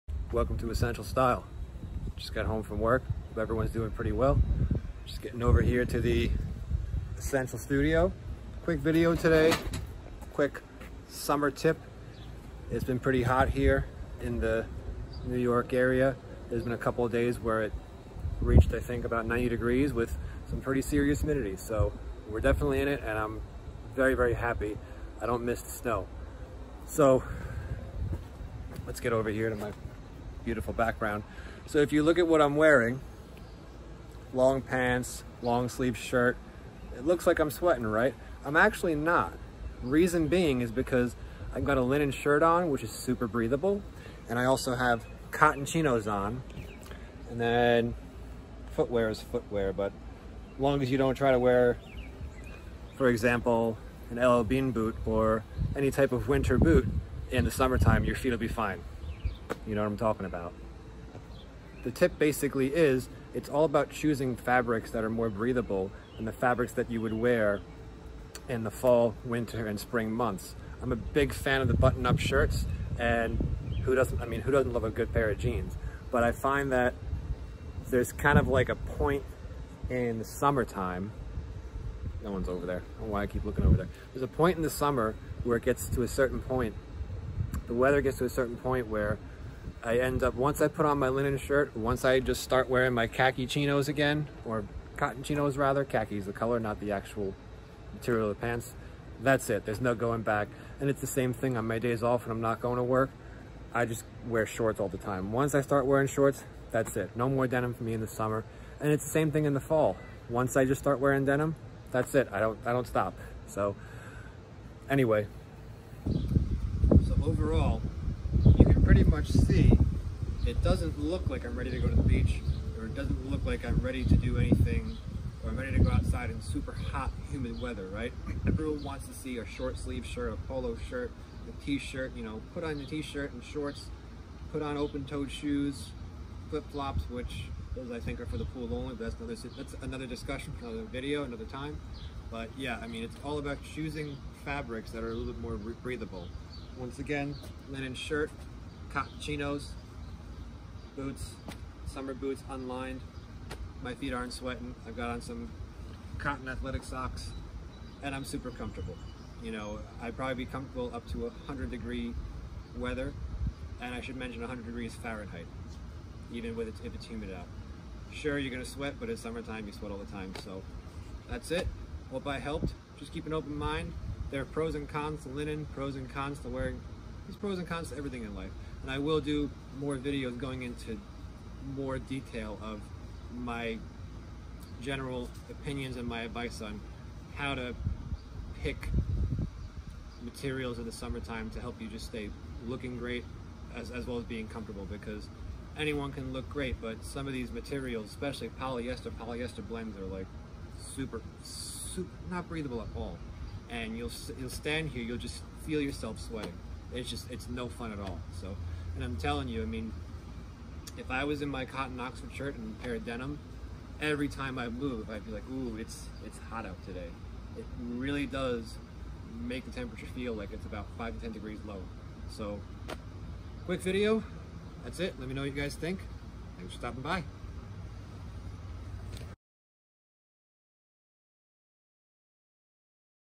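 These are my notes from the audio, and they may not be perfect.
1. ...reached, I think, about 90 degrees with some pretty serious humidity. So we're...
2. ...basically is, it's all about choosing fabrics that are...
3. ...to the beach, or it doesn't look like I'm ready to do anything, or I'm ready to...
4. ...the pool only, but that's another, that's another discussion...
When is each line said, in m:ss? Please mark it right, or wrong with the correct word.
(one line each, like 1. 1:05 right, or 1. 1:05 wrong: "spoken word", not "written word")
1. 0:18 right
2. 1:02 right
3. 2:01 right
4. 2:18 right.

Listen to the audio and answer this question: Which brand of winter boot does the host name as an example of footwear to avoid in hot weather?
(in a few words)
LL Bean.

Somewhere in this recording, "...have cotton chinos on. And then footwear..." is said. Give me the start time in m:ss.
0:44.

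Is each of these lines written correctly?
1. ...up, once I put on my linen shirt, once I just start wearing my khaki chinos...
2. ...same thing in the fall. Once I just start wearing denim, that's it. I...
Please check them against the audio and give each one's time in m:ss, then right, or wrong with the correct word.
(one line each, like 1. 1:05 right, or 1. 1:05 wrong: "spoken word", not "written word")
1. 1:30 right
2. 1:49 right.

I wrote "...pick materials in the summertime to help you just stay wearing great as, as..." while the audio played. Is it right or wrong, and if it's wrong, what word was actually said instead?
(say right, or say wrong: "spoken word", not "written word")
wrong: "looking", not "wearing".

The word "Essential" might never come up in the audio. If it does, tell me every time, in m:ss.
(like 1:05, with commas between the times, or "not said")
0:00, 0:07.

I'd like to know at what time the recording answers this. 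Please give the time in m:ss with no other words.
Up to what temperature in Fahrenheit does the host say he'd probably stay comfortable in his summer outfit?
2:41.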